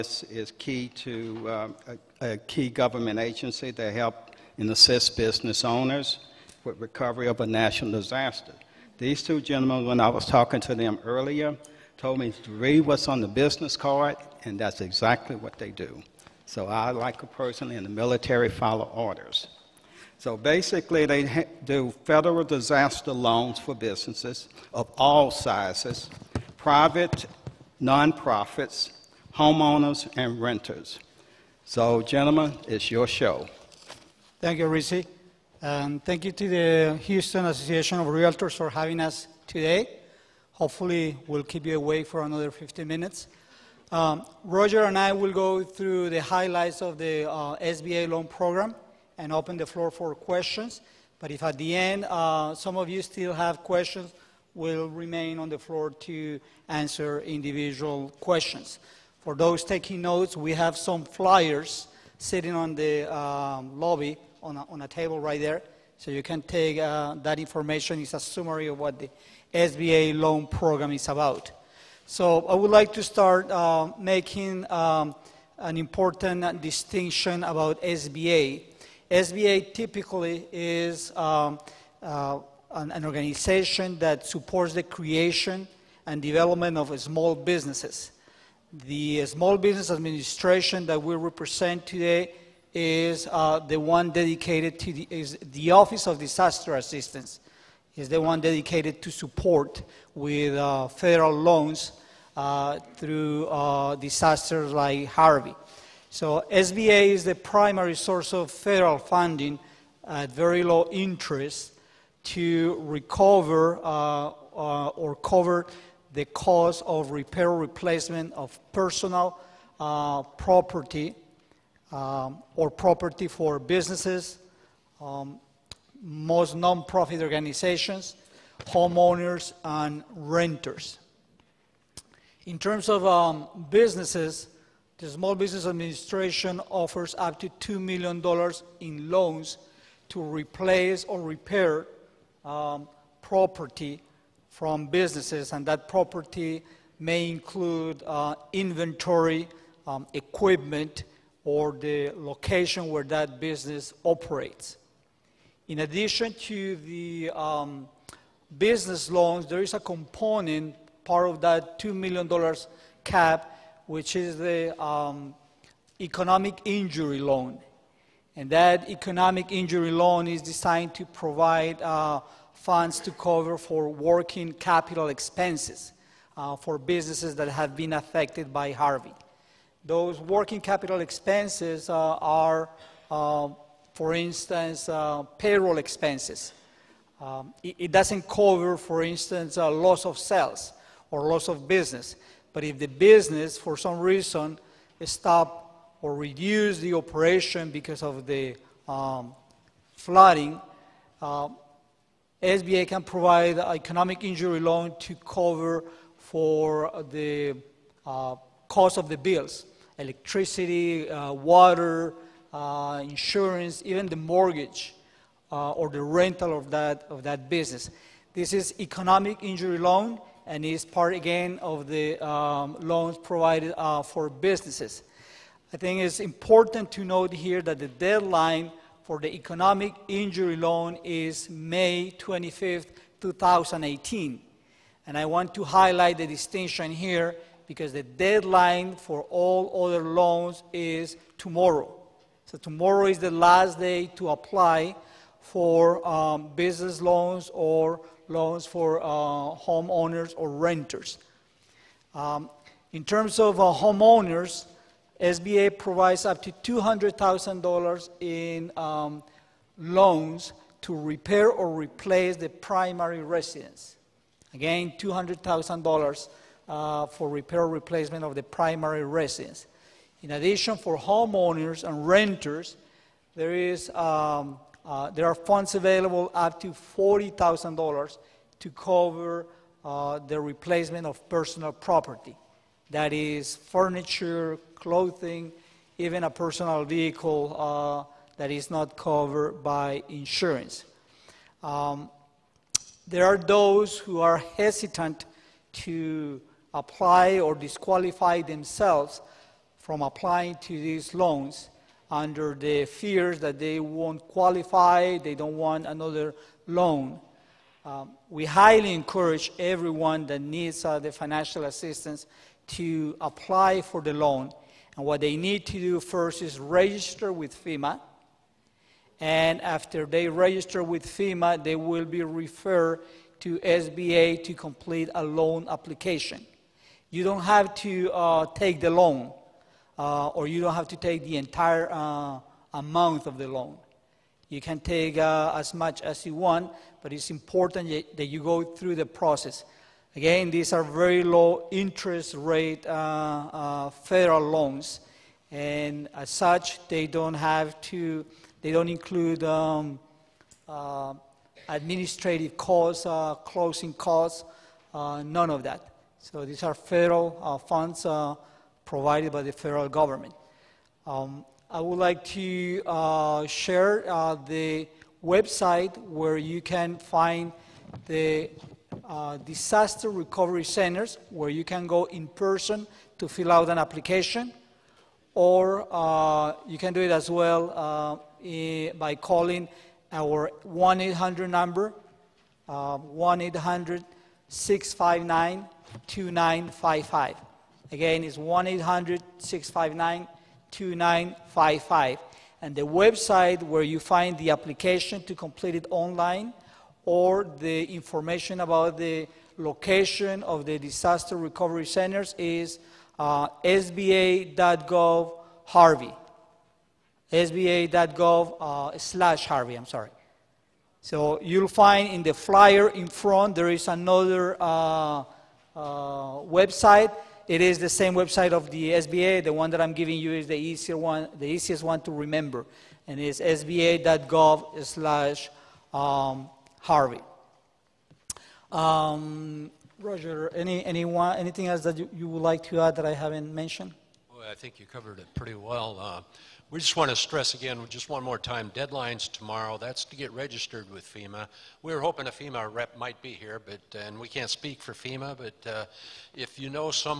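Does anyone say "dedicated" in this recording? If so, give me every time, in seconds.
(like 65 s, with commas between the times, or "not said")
94 s, 98 s.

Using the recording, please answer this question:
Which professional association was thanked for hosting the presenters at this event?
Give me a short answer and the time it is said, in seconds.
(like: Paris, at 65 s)
Houston Association of Realtors, at 37 s.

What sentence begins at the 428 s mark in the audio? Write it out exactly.
Um, um, Roger, any anyone anything else that you, you, would like to add that I haven't mentioned?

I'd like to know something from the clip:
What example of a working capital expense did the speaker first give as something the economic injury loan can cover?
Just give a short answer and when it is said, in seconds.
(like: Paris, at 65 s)
payroll expenses, at 185 s.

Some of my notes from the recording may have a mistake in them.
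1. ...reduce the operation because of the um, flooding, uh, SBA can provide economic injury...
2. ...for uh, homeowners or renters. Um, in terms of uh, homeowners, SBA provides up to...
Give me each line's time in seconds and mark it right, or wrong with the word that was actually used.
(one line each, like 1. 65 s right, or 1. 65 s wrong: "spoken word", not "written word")
1. 196 s right
2. 248 s right.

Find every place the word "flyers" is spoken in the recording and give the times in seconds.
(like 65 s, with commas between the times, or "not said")
61 s, 412 s.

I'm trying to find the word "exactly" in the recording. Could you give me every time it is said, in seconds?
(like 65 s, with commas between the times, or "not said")
14 s.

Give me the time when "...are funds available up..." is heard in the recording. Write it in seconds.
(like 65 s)
275 s.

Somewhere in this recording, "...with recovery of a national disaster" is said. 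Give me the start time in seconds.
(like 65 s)
6 s.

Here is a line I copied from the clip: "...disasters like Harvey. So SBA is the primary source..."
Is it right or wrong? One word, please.
right.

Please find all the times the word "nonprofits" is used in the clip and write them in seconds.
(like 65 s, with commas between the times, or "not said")
27 s, 126 s.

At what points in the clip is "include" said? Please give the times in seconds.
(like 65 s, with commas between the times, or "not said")
147 s, 348 s.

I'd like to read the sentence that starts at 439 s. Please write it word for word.
That's to get registered with FEMA.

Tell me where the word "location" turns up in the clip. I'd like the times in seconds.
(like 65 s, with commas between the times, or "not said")
152 s, 399 s.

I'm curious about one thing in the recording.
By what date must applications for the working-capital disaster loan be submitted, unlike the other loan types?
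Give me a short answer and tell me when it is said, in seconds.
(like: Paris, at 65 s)
May 25th, 2018, at 231 s.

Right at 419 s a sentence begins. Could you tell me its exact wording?
The one that I'm giving you is the easier one, the easiest one to remember, and it's sba.gov/harvey.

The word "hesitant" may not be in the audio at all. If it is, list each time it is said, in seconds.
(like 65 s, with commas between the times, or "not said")
294 s.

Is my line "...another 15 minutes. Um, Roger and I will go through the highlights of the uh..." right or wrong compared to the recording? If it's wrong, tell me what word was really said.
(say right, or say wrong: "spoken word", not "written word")
right.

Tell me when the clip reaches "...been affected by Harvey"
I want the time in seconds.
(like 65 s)
177 s.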